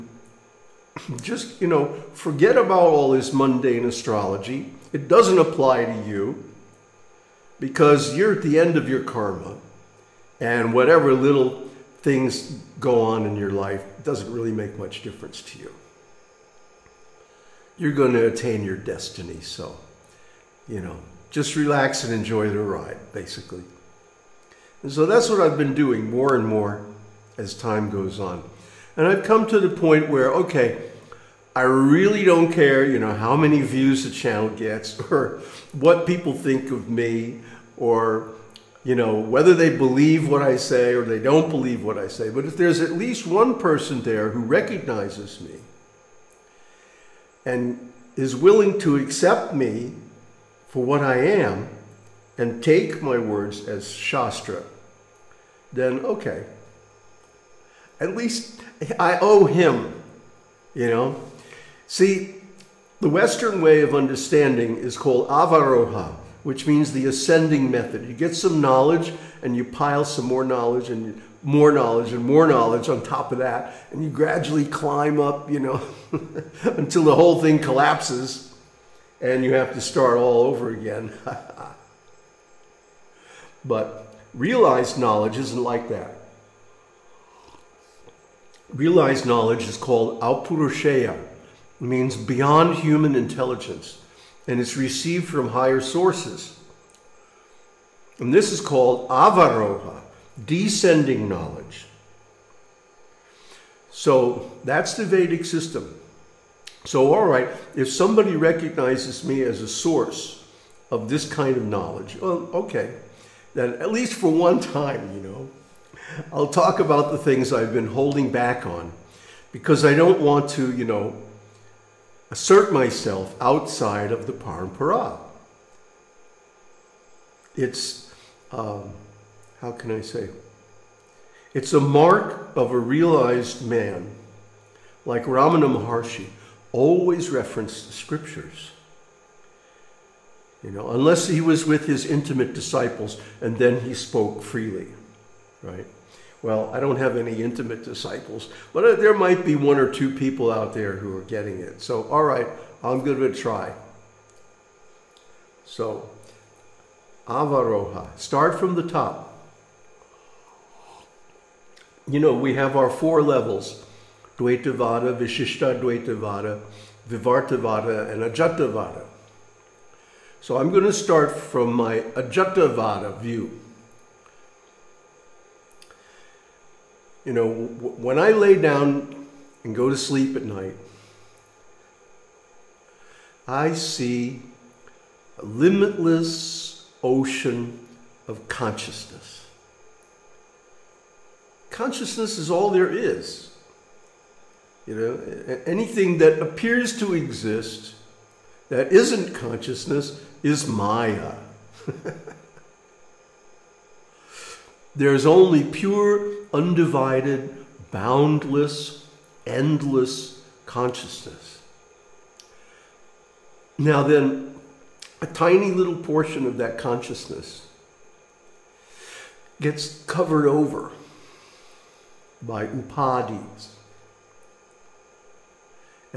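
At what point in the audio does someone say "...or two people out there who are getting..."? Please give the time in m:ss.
2:29.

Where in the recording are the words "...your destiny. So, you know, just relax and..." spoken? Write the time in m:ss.
0:18.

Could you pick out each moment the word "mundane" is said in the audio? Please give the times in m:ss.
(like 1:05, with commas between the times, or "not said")
0:03.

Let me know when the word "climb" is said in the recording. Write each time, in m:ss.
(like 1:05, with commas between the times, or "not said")
1:14.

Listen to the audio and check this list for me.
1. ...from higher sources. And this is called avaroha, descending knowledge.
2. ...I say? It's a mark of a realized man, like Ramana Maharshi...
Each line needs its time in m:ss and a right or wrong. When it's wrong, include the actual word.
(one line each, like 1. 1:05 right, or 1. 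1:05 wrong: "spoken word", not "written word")
1. 1:35 right
2. 2:09 right.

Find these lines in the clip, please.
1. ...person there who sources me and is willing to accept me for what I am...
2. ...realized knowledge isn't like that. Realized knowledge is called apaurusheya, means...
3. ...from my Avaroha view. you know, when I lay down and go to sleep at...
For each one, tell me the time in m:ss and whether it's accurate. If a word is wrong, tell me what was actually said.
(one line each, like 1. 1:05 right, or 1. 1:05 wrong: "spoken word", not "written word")
1. 0:43 wrong: "recognizes", not "sources"
2. 1:24 right
3. 2:51 wrong: "Ajatavada", not "Avaroha".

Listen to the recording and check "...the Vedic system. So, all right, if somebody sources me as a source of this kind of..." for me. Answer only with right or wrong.
wrong.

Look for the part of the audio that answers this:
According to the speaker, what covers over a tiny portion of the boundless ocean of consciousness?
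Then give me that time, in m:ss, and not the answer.
3:42.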